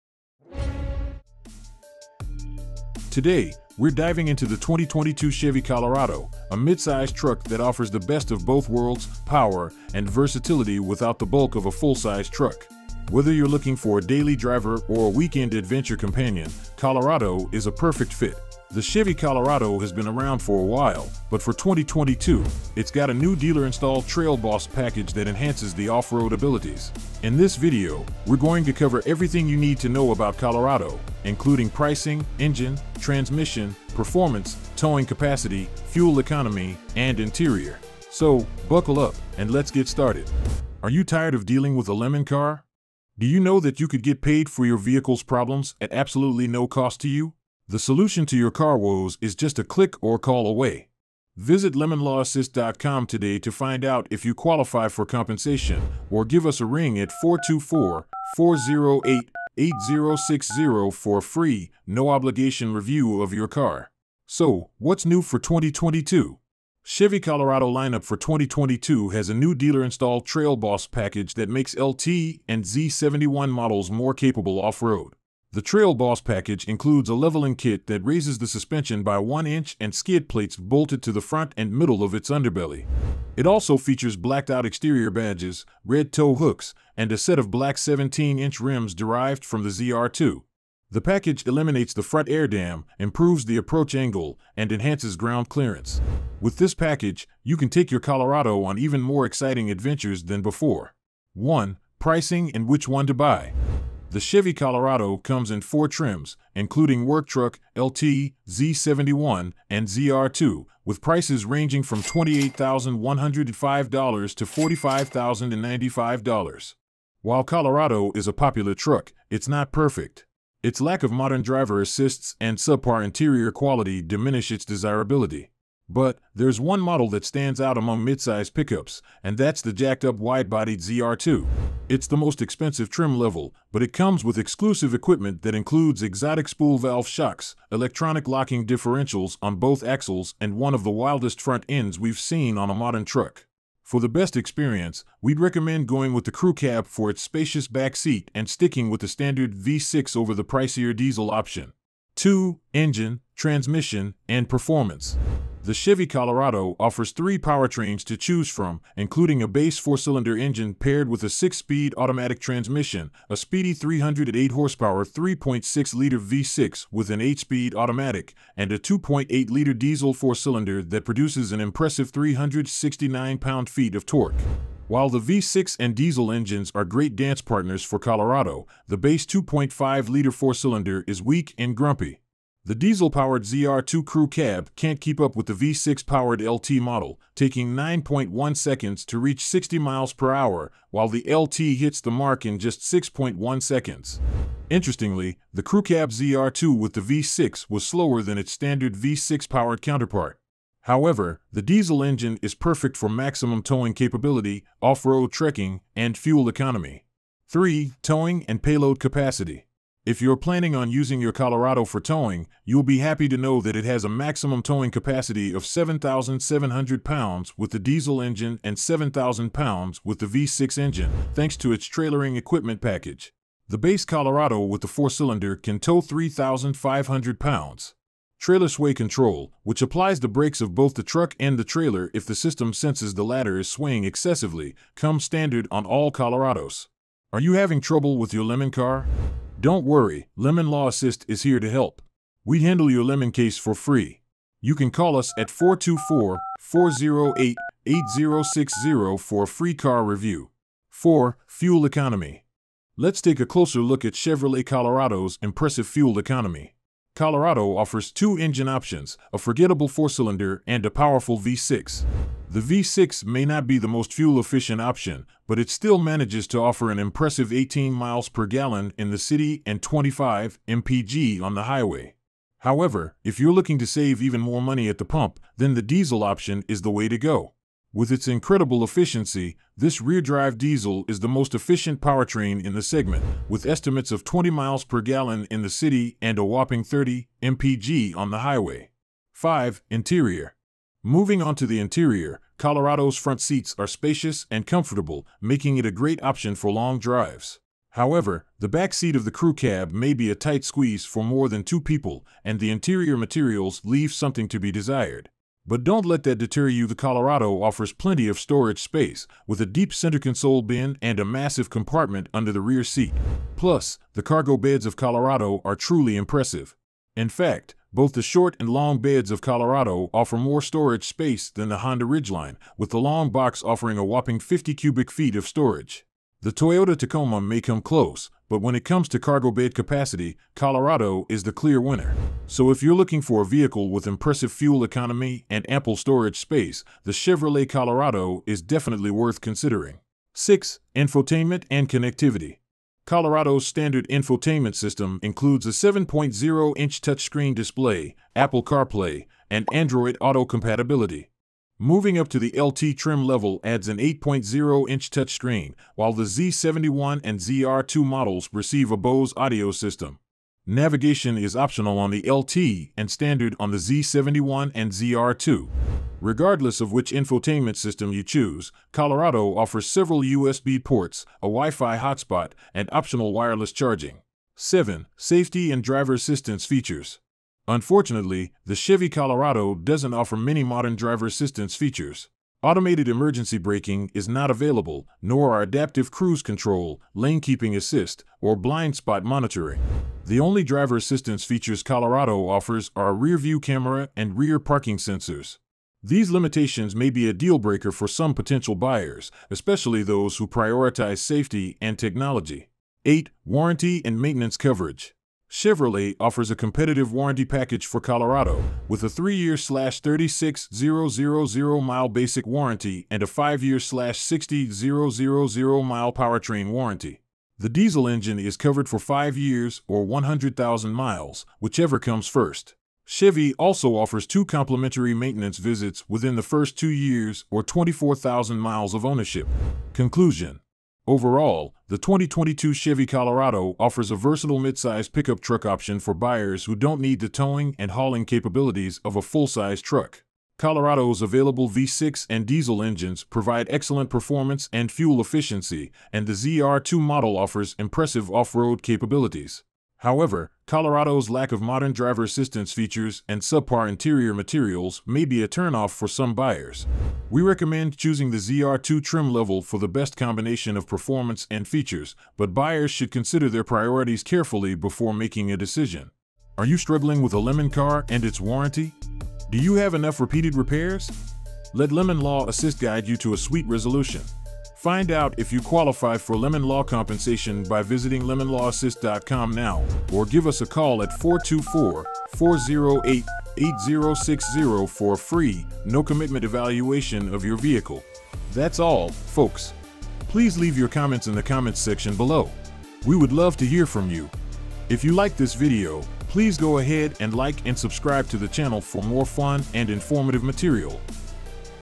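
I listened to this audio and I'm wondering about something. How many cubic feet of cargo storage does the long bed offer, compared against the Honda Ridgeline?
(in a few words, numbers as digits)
50 cubic feet.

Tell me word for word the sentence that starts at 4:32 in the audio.
However, if you're looking to save even more money at the pump, then the diesel option is the way to go.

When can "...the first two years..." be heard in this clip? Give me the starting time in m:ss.
7:06.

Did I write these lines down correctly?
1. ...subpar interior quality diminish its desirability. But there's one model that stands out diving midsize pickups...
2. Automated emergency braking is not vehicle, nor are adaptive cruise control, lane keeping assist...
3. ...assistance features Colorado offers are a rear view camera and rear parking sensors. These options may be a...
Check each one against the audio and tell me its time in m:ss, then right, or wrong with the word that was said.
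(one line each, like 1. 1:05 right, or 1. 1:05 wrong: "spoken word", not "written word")
1. 2:02 wrong: "among", not "diving"
2. 6:22 wrong: "available", not "vehicle"
3. 6:30 wrong: "limitations", not "options".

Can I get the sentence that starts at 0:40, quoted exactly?
Are you tired of dealing with a lemon car?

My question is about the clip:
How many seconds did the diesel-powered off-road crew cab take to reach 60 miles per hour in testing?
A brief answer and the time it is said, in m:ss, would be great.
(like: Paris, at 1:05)
9.1 seconds, at 3:07.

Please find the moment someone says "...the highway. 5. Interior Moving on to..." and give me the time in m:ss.
4:48.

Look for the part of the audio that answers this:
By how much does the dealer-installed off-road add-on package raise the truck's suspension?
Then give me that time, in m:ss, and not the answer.
1:19.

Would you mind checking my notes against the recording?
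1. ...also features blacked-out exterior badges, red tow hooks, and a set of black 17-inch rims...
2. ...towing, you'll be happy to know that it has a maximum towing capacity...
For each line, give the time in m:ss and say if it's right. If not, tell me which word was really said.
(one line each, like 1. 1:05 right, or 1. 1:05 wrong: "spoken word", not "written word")
1. 1:23 right
2. 3:31 right.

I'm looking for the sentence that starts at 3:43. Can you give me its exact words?
The base Colorado with the four-cylinder can tow 3,500 pounds.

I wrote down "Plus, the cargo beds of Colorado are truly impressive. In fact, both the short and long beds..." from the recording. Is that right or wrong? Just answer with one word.
right.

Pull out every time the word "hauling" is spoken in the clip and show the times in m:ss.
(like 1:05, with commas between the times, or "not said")
7:17.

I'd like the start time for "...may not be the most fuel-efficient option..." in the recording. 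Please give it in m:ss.
4:23.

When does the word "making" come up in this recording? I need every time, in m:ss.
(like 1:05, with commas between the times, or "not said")
4:55, 7:45.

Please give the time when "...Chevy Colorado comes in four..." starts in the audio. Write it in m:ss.
1:44.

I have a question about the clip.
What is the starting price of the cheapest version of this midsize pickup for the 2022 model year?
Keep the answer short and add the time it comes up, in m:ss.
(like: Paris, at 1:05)
$28,105, at 1:52.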